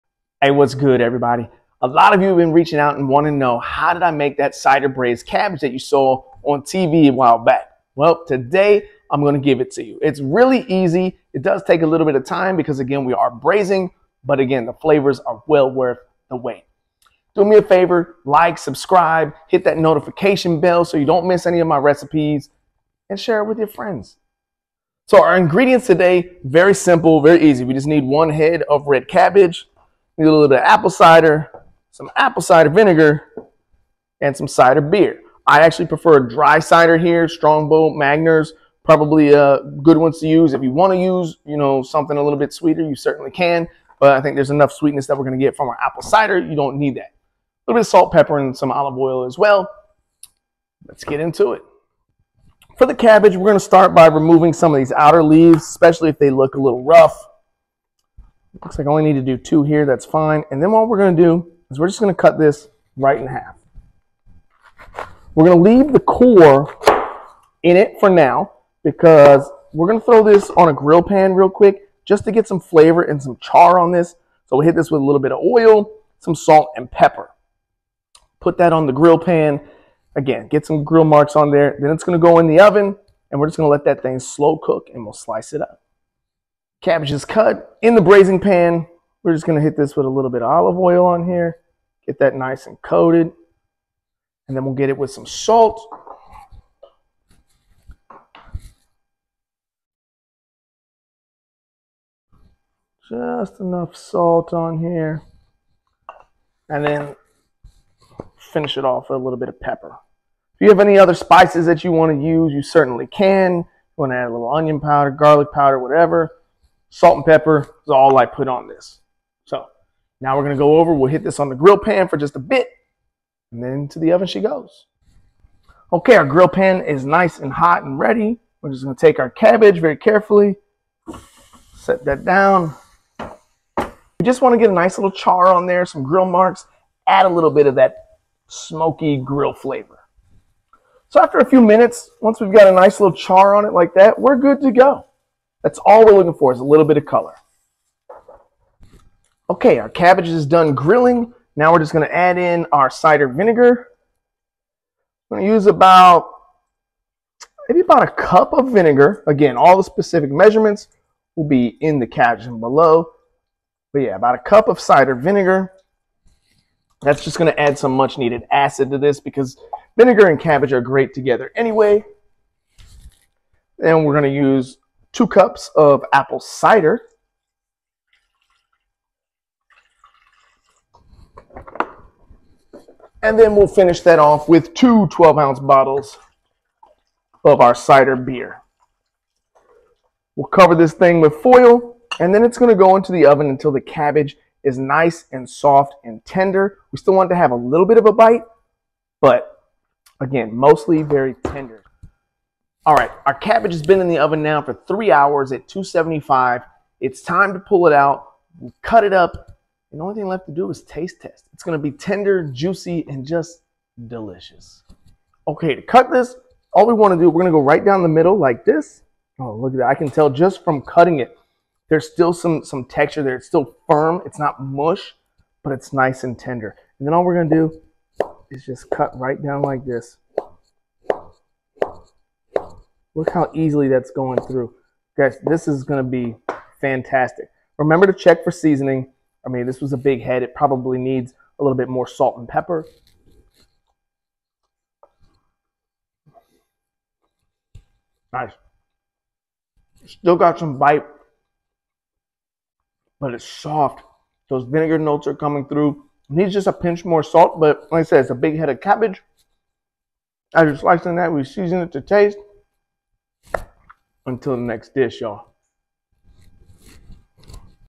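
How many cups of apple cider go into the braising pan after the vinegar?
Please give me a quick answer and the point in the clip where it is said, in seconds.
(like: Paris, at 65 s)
2 cups, at 175 s.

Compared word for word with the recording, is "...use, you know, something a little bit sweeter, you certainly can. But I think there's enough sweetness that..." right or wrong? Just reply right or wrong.
right.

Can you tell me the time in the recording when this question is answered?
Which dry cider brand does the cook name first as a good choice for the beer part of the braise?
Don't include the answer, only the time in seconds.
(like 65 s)
37 s.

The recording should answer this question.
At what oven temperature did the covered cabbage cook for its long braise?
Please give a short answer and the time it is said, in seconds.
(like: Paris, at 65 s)
275, at 205 s.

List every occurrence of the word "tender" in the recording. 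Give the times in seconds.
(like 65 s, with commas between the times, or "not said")
196 s, 201 s, 211 s, 226 s.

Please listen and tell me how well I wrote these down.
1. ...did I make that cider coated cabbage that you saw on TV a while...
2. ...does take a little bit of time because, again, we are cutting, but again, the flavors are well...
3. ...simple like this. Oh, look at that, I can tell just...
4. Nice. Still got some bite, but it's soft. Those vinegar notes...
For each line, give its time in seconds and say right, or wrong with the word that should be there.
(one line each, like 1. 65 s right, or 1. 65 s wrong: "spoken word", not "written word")
1. 3 s wrong: "braised", not "coated"
2. 11 s wrong: "braising", not "cutting"
3. 218 s wrong: "middle", not "simple"
4. 248 s right.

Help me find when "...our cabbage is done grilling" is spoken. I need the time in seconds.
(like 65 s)
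149 s.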